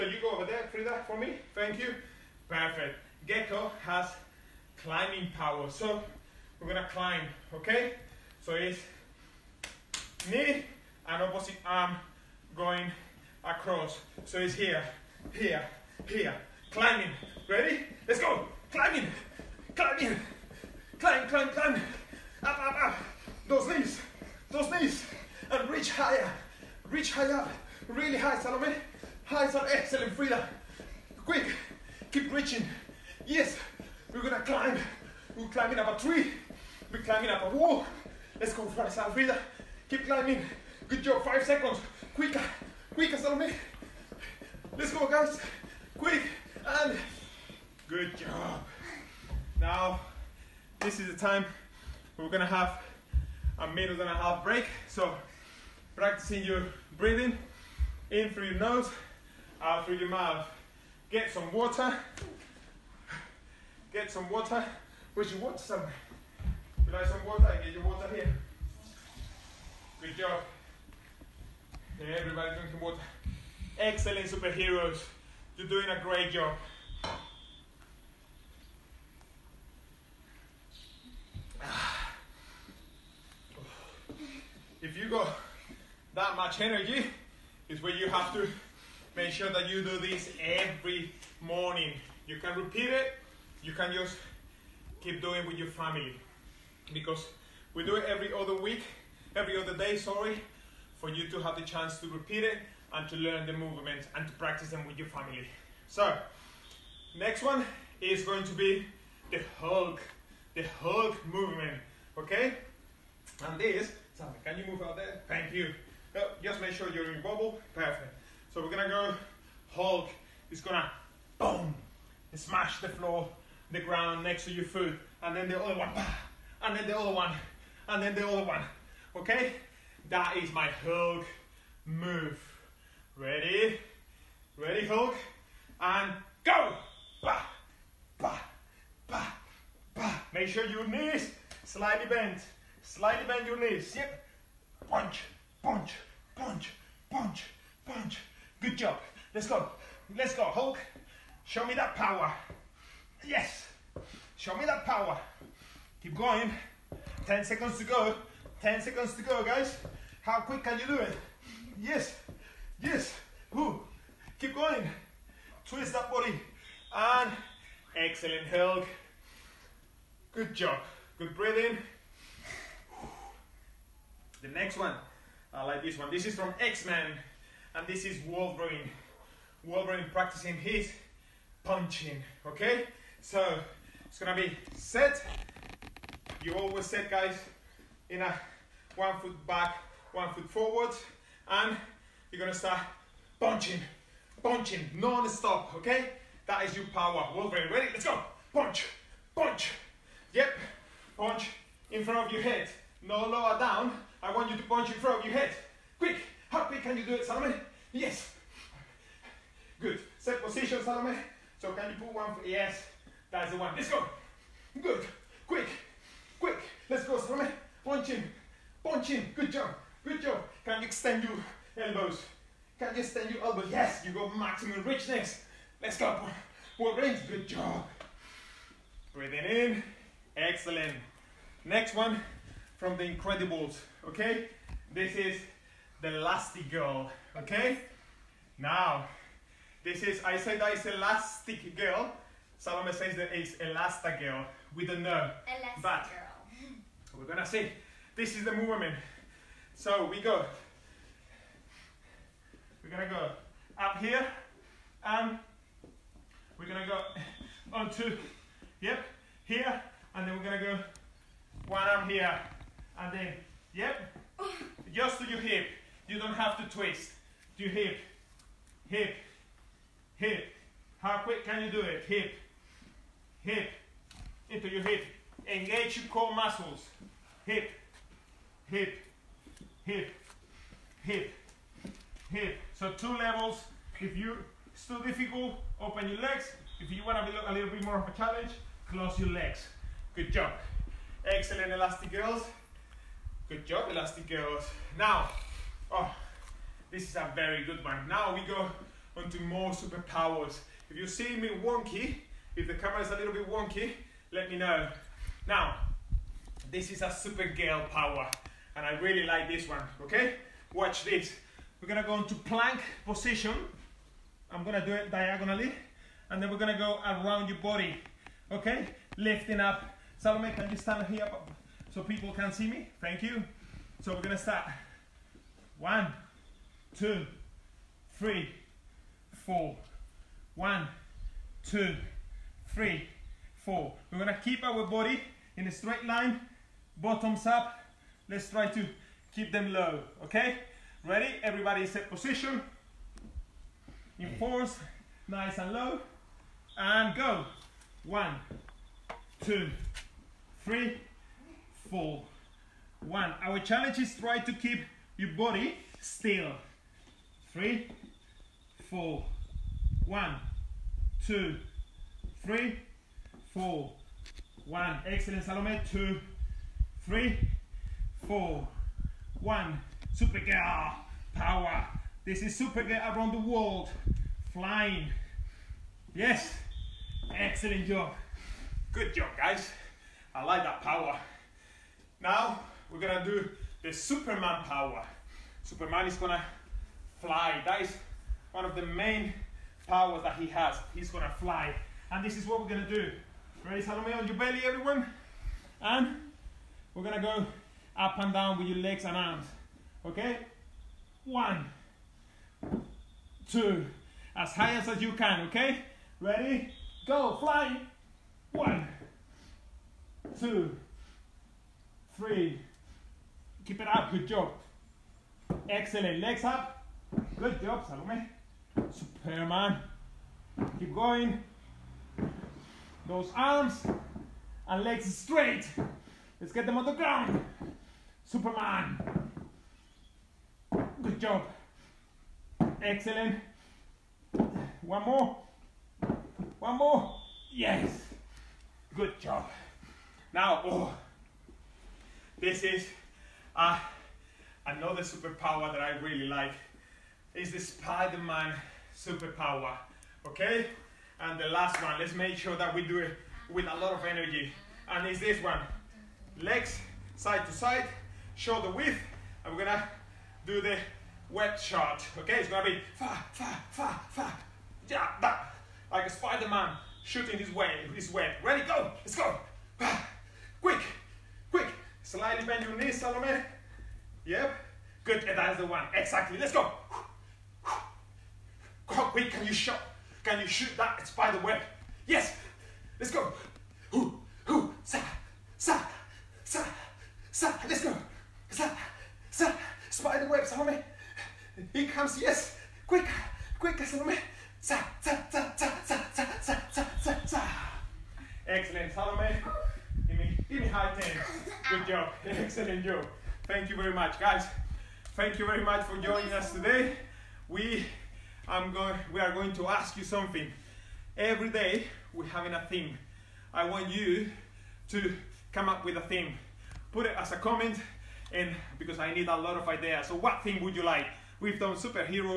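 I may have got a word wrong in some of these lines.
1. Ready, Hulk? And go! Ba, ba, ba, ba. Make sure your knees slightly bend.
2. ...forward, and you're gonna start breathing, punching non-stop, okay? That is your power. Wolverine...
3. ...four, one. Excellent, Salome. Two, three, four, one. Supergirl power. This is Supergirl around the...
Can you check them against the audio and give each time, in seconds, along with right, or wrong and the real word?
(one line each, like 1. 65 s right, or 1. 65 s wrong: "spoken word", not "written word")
1. 134 s right
2. 190 s wrong: "punching", not "breathing"
3. 363 s right.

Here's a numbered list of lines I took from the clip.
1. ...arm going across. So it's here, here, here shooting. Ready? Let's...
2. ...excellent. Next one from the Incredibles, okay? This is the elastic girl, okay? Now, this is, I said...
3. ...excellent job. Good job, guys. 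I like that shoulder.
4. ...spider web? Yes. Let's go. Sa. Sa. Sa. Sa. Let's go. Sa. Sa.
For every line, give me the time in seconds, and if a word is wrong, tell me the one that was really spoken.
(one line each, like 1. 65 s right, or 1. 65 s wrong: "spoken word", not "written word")
1. 11 s wrong: "climbing", not "shooting"
2. 230 s right
3. 377 s wrong: "power", not "shoulder"
4. 481 s right.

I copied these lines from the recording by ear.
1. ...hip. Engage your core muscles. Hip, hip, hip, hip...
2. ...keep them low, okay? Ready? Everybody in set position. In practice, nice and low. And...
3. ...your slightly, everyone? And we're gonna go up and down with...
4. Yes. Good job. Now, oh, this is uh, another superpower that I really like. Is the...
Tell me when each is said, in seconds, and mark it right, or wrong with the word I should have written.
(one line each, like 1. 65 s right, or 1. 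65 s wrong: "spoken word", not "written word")
1. 274 s right
2. 339 s wrong: "force", not "practice"
3. 394 s wrong: "belly", not "slightly"
4. 437 s right.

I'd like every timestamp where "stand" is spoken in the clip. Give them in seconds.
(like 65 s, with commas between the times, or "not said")
223 s, 320 s.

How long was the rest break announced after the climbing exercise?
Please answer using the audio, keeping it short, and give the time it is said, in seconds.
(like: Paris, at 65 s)
A minute and a half, at 53 s.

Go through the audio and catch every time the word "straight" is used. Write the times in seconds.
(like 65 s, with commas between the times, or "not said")
335 s, 425 s.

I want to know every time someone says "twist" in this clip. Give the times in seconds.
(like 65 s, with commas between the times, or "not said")
165 s, 266 s.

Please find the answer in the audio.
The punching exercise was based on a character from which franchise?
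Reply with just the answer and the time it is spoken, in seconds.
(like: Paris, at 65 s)
X-Men, at 176 s.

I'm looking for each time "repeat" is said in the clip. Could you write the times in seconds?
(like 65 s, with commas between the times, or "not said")
92 s, 102 s.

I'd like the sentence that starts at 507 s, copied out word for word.
We, I'm going, we are going to ask you something.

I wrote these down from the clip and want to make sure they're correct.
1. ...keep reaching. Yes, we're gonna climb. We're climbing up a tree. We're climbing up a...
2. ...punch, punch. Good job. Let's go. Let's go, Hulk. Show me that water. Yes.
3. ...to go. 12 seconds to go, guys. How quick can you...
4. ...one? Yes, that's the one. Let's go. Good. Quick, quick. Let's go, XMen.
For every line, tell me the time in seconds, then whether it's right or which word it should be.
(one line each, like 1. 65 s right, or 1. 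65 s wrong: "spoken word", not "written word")
1. 32 s right
2. 147 s wrong: "power", not "water"
3. 157 s wrong: "10", not "12"
4. 212 s wrong: "Salome", not "XMen".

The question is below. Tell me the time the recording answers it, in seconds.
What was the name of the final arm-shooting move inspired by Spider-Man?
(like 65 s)
461 s.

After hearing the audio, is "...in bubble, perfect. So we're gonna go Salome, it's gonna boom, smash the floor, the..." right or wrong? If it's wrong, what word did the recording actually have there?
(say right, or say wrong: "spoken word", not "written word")
wrong: "Hulk", not "Salome".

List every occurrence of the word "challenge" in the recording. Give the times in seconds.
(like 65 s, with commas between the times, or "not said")
288 s, 353 s.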